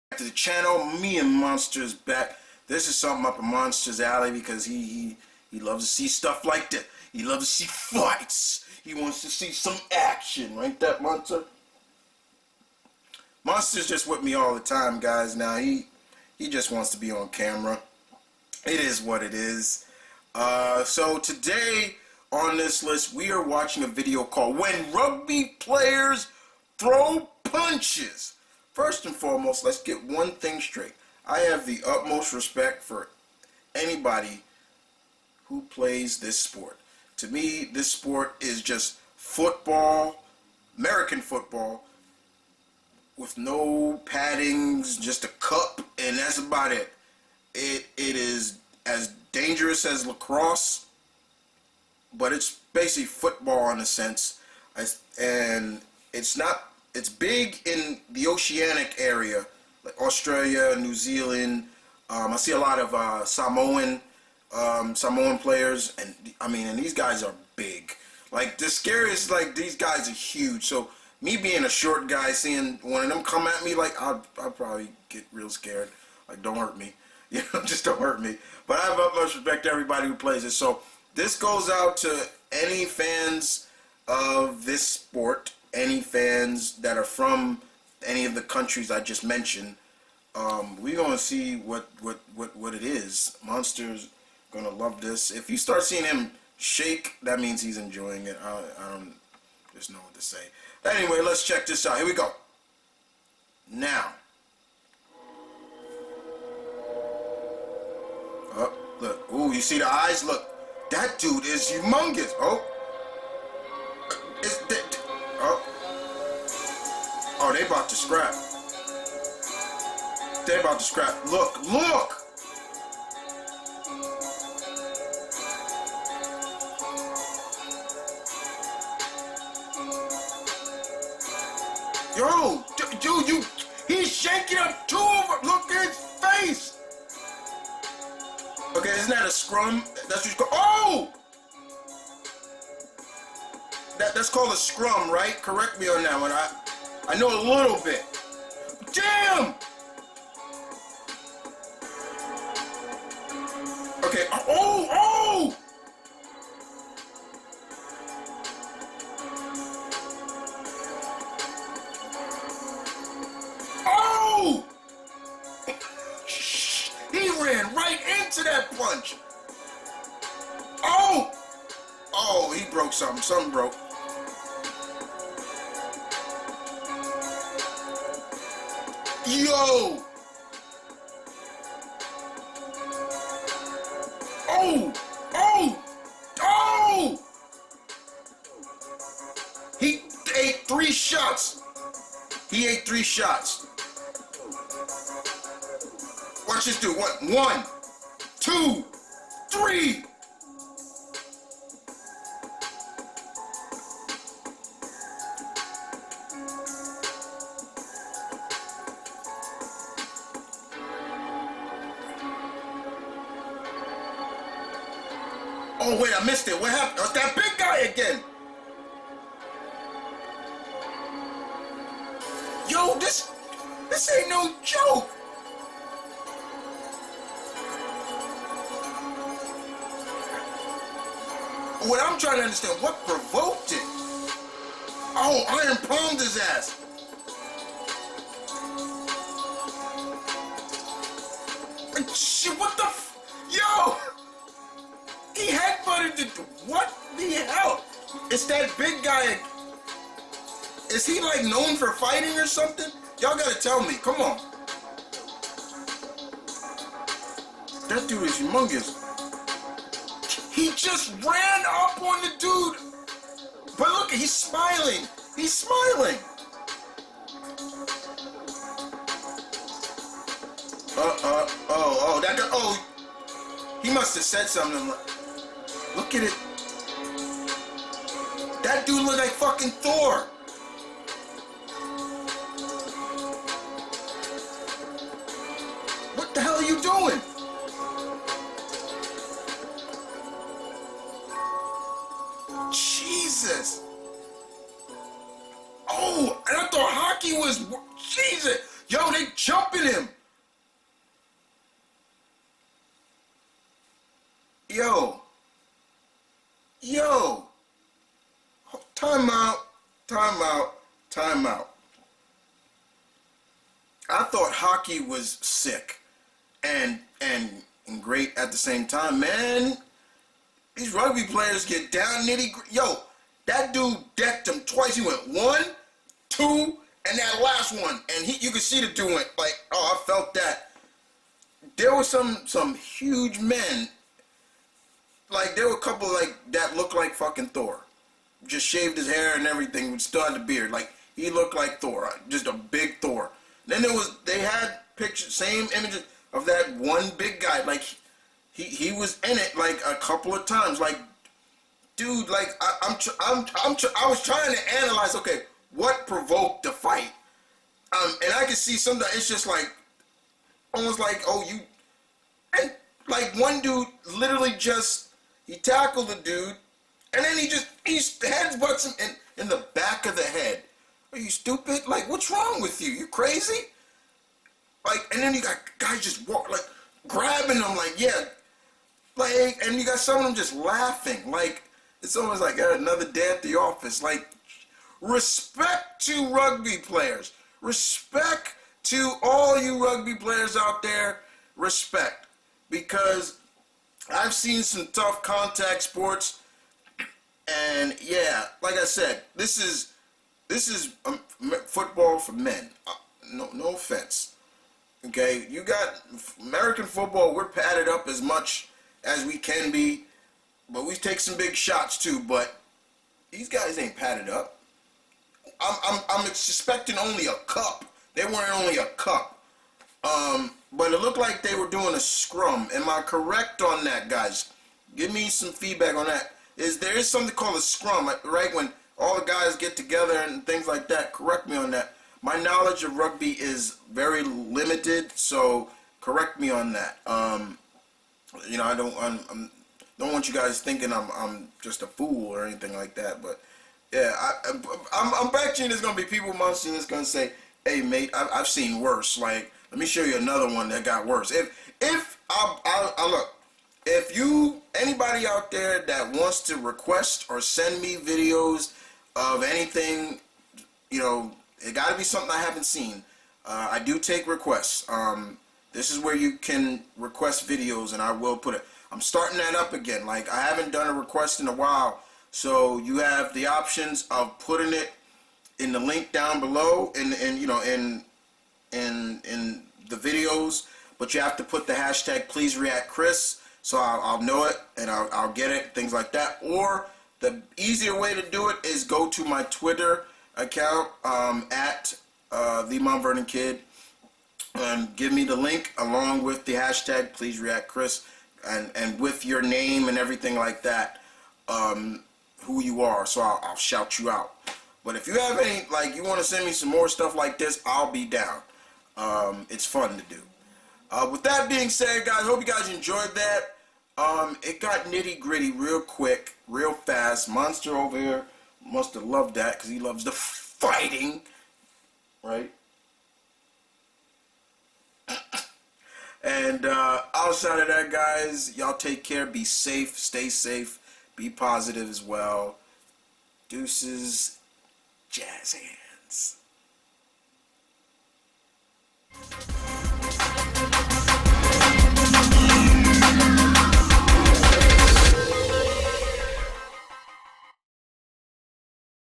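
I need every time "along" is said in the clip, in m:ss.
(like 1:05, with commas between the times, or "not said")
8:15.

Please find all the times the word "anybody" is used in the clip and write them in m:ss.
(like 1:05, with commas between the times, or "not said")
0:33, 7:34.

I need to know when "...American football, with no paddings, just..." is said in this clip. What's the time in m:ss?
0:40.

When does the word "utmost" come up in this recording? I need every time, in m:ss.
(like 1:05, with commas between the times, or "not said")
0:31, 1:18.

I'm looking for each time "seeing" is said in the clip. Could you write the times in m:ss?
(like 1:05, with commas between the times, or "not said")
1:12, 1:35.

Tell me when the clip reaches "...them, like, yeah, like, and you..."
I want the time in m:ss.
6:17.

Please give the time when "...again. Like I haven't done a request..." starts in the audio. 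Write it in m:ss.
7:49.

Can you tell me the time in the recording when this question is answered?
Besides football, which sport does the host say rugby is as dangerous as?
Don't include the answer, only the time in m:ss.
0:50.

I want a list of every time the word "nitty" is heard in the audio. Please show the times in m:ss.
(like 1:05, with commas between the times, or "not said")
5:22, 8:34.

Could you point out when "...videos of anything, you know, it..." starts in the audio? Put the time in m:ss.
7:37.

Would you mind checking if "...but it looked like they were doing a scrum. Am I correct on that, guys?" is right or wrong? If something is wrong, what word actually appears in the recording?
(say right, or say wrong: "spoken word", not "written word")
right.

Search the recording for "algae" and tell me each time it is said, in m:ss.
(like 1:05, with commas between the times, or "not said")
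not said.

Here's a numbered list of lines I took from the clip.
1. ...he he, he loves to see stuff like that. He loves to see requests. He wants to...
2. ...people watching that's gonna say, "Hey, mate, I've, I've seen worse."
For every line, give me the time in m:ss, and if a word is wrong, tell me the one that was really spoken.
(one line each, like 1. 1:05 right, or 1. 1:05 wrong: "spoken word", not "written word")
1. 0:04 wrong: "fights", not "requests"
2. 7:26 right.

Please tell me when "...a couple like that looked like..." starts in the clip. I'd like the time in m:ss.
5:35.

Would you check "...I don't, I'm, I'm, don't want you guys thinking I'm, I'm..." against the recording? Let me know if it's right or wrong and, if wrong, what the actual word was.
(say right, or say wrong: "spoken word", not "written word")
right.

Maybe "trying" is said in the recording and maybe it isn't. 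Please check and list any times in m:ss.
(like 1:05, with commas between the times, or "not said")
3:52, 5:54.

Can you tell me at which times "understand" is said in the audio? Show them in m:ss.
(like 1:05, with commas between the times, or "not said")
3:52.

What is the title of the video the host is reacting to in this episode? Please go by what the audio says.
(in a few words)
When Rugby Players Throw Punches.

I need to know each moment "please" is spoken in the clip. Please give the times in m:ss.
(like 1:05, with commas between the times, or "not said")
8:02, 8:17.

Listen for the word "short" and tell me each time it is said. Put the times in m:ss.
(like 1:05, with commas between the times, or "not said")
1:11.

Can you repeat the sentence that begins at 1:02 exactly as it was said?
Um, I see a lot of uh, Samoan um, Samoan players, and I mean, and these guys are big.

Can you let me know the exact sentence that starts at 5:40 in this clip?
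Like he looked like Thor, uh, just a big Thor.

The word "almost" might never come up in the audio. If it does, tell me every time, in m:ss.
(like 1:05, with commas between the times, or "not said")
6:00, 6:22.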